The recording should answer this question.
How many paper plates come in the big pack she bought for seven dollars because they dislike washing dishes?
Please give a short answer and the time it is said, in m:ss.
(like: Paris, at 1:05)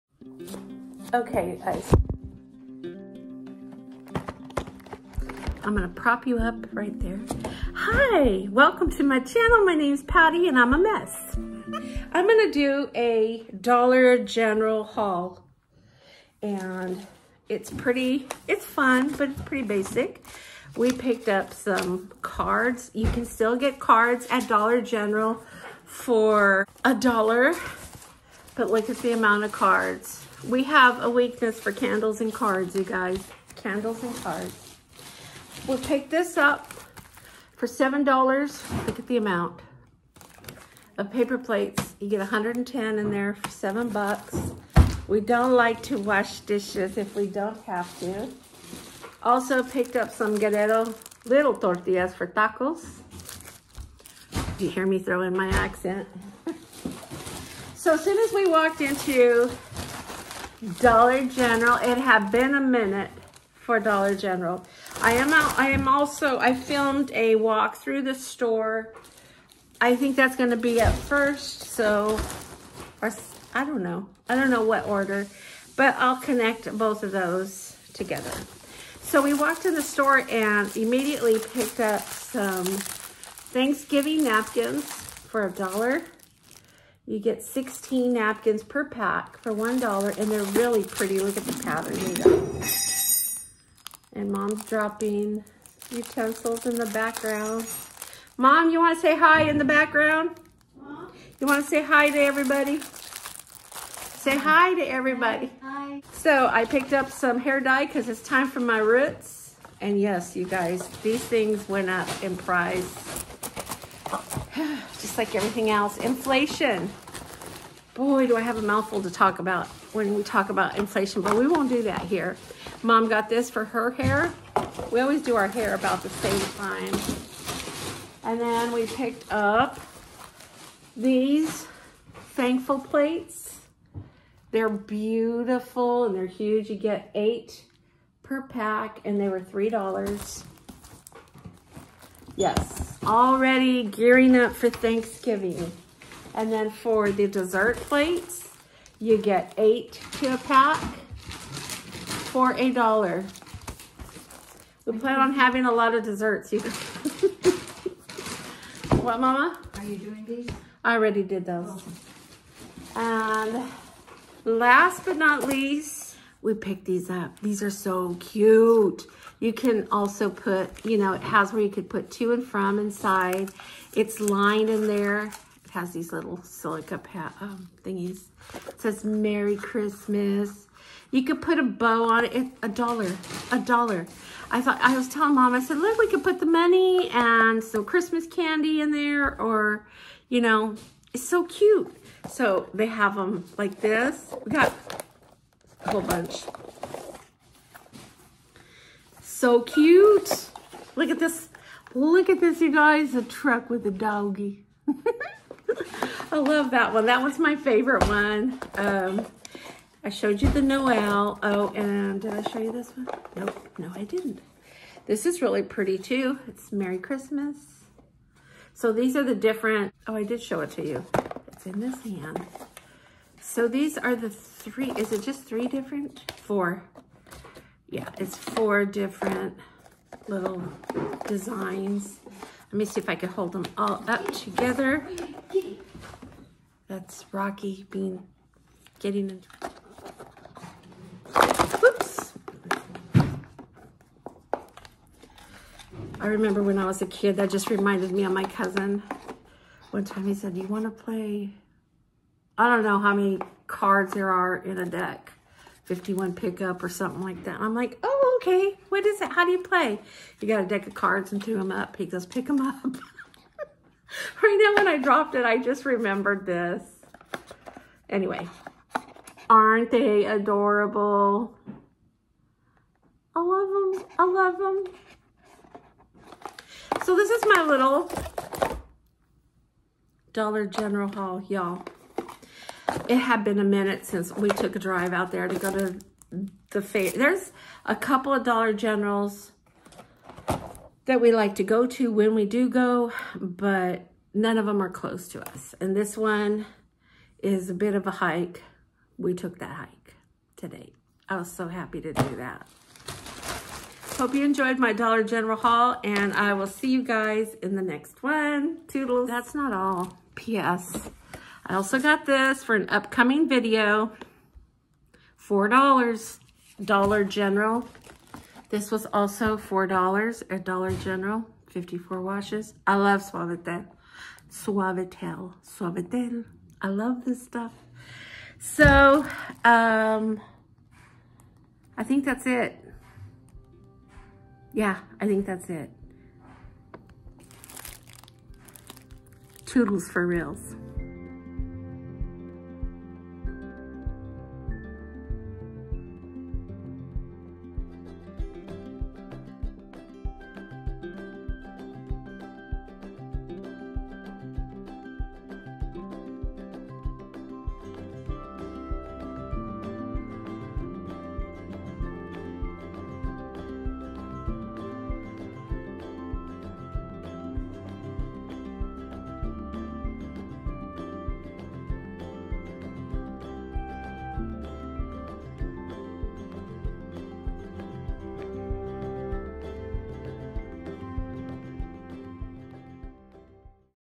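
110, at 0:42.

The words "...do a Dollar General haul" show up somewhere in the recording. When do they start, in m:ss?
0:12.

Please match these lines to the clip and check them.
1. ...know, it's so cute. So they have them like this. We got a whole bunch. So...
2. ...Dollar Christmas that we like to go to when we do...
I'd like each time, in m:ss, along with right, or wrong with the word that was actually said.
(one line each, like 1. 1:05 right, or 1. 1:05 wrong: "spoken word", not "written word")
1. 3:10 right
2. 4:48 wrong: "Generals", not "Christmas".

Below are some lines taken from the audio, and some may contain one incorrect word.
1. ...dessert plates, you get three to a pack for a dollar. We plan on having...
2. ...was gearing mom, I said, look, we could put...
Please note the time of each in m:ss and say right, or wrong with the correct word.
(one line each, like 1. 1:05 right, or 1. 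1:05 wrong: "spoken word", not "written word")
1. 2:27 wrong: "eight", not "three"
2. 3:04 wrong: "telling", not "gearing".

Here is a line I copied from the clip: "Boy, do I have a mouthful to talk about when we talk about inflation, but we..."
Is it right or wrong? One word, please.
right.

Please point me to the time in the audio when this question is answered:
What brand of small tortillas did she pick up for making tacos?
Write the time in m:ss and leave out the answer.
0:50.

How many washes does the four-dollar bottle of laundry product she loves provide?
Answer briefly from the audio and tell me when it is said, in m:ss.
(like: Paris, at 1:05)
54, at 5:21.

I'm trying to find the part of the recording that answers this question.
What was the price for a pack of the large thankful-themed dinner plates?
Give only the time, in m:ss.
2:19.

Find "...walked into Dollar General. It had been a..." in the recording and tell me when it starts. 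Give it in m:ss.
0:58.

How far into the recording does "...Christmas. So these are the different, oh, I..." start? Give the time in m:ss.
3:36.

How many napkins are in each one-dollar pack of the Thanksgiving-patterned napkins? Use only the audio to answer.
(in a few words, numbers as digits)
16.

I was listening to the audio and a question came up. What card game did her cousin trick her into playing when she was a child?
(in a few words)
51 pickup.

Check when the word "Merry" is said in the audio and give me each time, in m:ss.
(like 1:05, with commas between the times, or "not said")
2:59, 3:36.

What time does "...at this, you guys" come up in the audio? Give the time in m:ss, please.
3:22.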